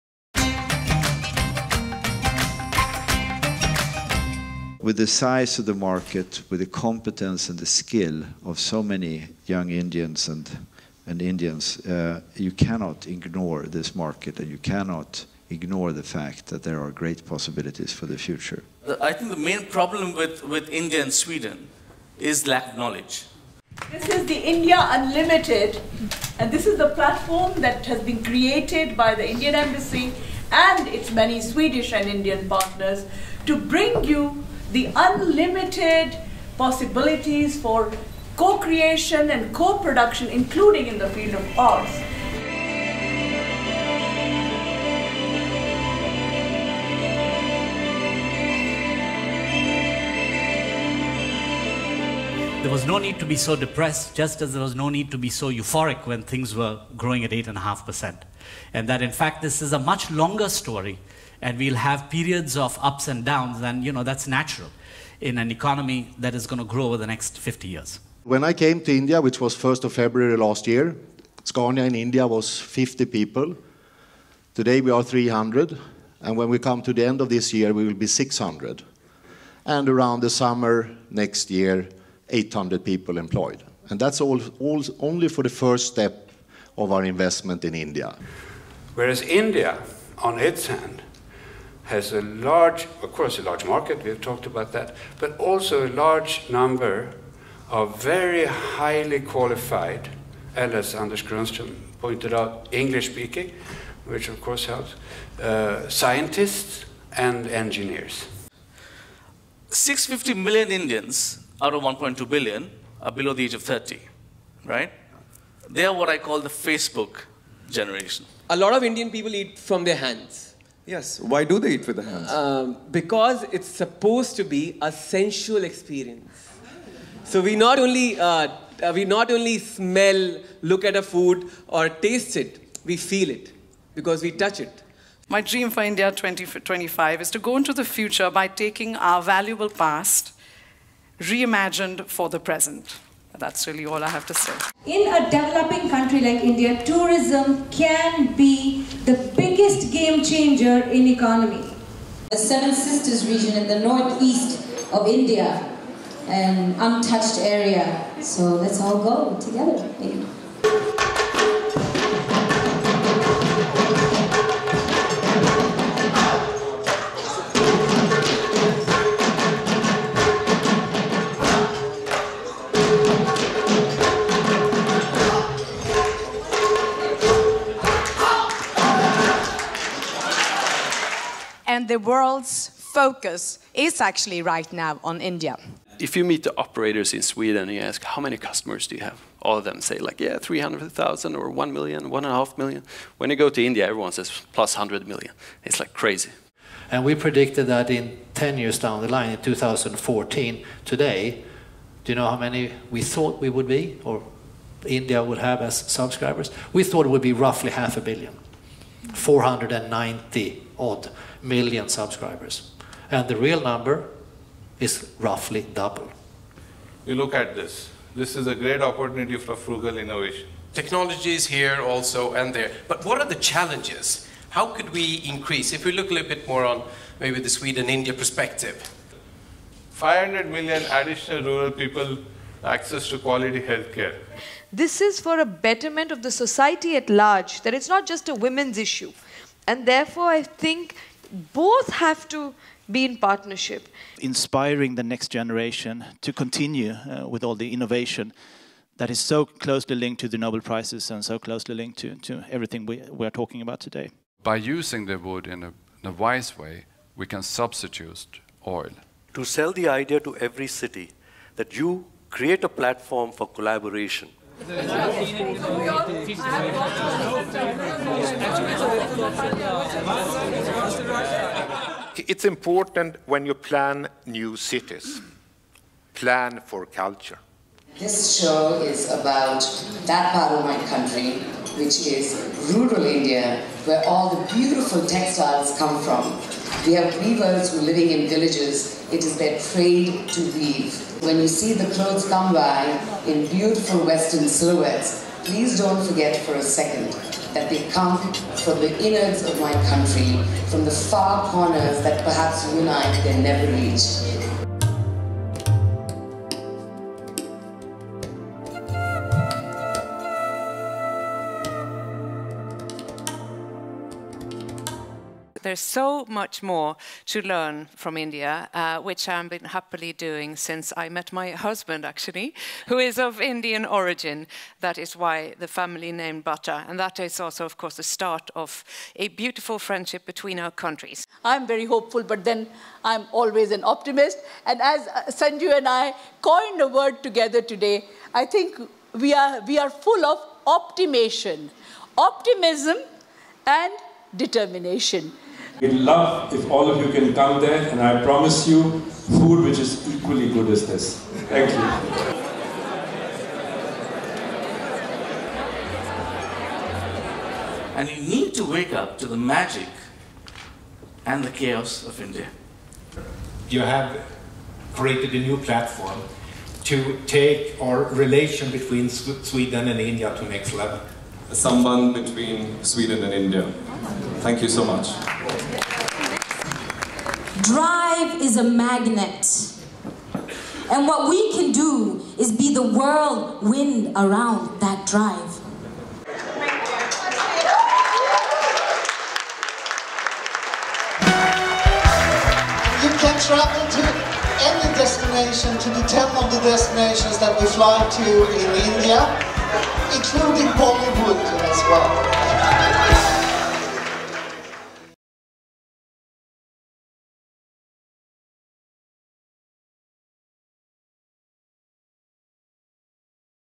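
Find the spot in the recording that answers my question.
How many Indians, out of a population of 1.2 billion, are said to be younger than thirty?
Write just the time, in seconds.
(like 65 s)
109 s.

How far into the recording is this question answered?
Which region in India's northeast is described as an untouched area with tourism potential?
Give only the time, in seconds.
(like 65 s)
152 s.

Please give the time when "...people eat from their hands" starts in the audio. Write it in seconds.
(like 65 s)
119 s.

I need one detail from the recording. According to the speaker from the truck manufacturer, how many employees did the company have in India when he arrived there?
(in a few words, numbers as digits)
50.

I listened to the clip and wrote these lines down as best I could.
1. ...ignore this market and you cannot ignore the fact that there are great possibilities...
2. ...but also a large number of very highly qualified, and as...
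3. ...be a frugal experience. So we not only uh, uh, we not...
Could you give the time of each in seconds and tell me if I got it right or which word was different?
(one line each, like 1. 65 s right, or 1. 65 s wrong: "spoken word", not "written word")
1. 13 s right
2. 95 s right
3. 124 s wrong: "sensual", not "frugal".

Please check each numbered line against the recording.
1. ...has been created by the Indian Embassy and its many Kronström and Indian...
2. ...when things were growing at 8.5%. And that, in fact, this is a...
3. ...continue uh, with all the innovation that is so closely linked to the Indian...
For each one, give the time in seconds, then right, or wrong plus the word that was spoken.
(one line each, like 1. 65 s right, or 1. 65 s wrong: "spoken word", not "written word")
1. 27 s wrong: "Swedish", not "Kronström"
2. 56 s right
3. 246 s wrong: "Nobel", not "Indian".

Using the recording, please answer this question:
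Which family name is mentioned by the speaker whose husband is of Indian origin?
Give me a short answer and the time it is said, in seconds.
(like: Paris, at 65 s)
Butter, at 326 s.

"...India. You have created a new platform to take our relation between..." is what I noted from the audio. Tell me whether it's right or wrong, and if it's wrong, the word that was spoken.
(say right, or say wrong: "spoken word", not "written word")
right.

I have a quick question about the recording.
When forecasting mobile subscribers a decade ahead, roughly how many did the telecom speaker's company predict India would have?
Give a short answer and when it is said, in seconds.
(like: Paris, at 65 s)
490 million, at 209 s.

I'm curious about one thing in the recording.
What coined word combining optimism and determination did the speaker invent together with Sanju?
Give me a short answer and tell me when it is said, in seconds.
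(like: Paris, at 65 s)
optimation, at 340 s.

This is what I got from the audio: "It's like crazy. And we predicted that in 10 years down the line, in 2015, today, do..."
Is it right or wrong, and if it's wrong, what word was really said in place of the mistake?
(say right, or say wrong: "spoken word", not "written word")
wrong: "2014", not "2015".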